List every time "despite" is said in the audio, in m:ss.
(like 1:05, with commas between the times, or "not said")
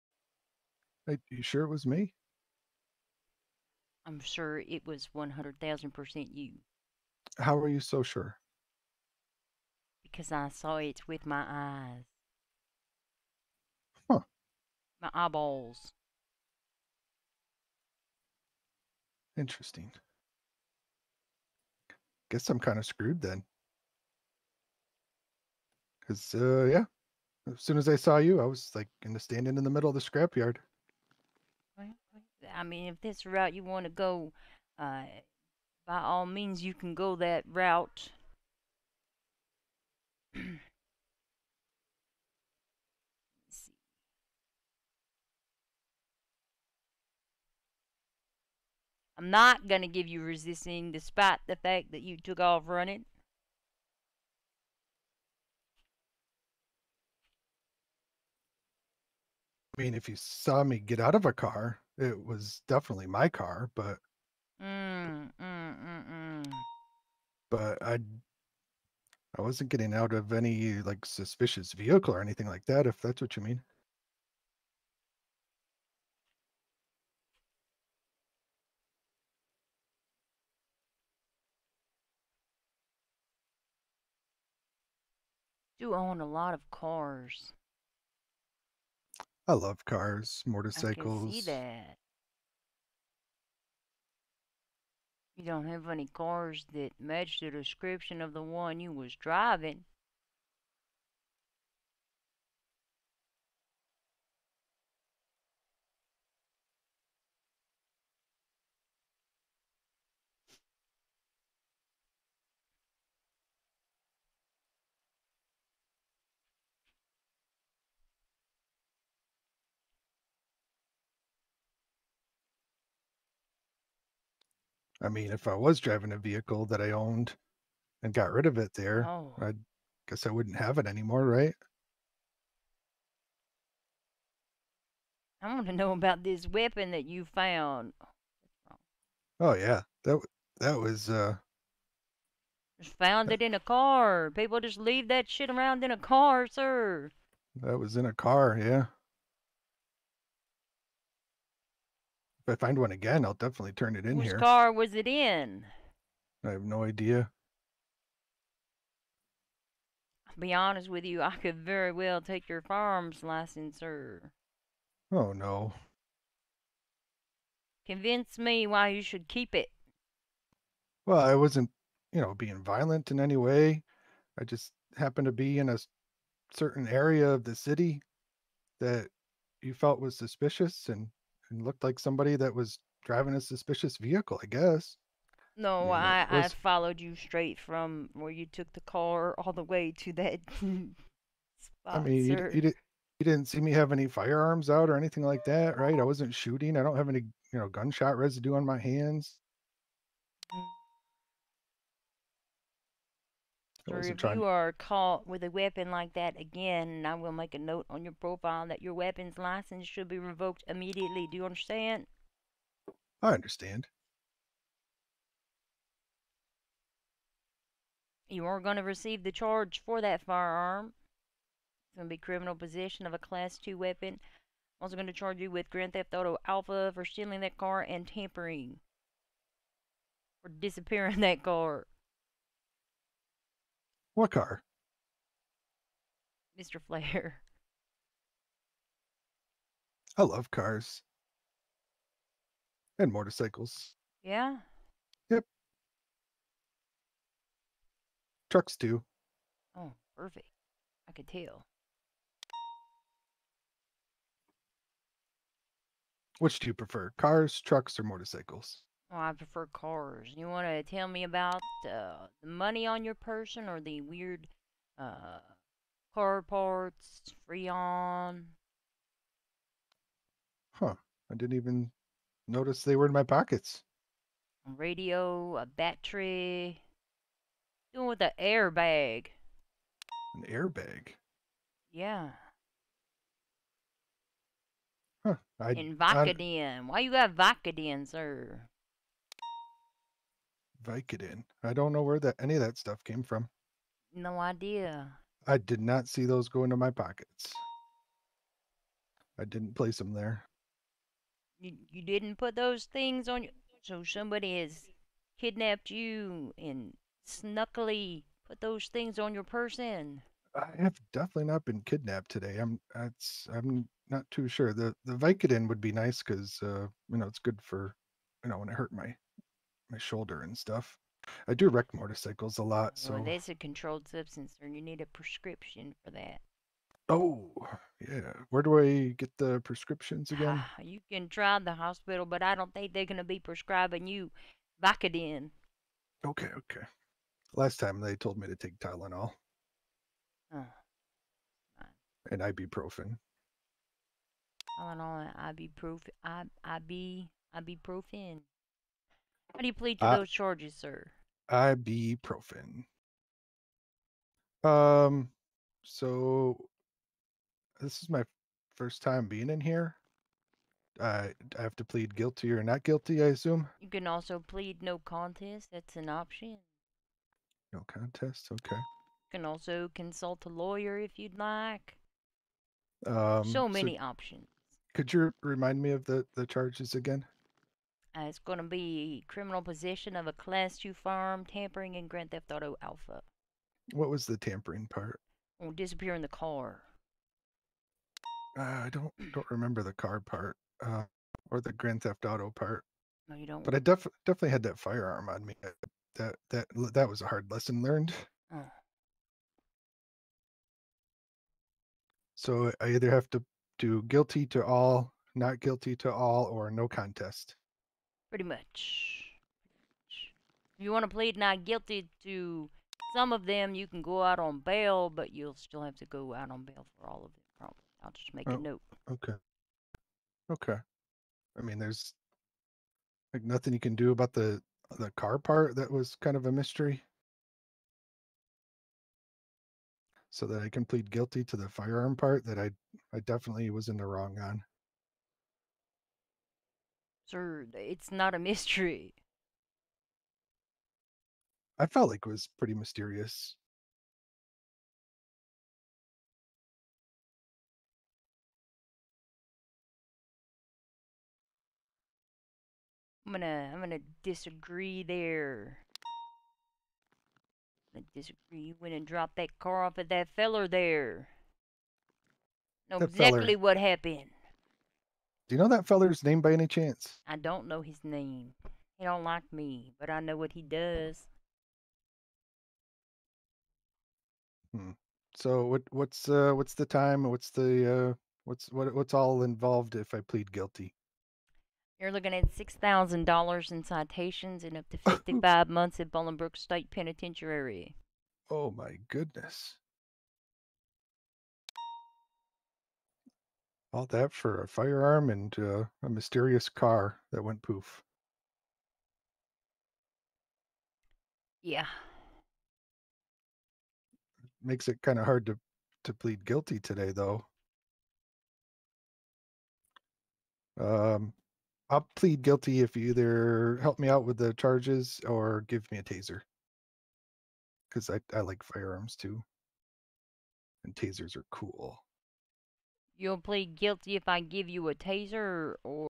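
0:50.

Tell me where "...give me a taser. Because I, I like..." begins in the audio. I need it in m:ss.
8:35.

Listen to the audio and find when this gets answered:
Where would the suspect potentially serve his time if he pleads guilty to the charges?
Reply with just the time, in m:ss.
8:06.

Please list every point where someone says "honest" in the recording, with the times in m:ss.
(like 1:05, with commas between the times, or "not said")
2:40.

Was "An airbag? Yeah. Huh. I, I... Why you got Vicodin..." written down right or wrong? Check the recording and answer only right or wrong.
right.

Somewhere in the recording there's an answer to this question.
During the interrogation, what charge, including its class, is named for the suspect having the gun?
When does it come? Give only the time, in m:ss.
3:42.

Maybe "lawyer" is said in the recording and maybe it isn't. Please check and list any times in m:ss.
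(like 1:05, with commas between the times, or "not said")
6:10.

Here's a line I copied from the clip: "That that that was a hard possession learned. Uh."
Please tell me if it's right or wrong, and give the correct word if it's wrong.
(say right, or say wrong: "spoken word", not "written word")
wrong: "lesson", not "possession".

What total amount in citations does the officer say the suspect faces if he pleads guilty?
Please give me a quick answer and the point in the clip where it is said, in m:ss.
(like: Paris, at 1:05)
$6,000, at 8:02.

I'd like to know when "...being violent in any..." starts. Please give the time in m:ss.
2:52.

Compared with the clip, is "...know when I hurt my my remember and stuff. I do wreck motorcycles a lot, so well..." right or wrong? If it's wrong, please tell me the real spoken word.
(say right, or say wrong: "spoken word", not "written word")
wrong: "shoulder", not "remember".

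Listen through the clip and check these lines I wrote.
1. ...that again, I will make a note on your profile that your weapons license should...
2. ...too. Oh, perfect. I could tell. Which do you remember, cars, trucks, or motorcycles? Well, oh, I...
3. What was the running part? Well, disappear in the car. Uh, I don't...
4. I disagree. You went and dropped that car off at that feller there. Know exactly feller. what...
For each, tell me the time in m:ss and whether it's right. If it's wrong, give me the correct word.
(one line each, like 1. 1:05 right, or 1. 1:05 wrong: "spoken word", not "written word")
1. 3:26 right
2. 4:08 wrong: "prefer", not "remember"
3. 6:23 wrong: "tampering", not "running"
4. 7:37 right.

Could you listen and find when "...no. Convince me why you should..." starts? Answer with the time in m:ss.
2:45.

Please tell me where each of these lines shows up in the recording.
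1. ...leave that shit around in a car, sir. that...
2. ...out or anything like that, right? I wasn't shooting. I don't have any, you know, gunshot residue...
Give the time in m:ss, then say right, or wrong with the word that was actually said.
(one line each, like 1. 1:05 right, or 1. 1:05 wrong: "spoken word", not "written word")
1. 2:24 right
2. 3:14 right.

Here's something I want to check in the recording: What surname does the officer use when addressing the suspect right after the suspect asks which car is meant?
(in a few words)
Flair.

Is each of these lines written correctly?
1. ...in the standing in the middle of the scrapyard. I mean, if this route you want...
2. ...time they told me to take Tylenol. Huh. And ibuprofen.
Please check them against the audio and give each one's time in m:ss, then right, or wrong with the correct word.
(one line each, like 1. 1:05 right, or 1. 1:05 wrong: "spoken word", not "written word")
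1. 0:29 right
2. 5:37 right.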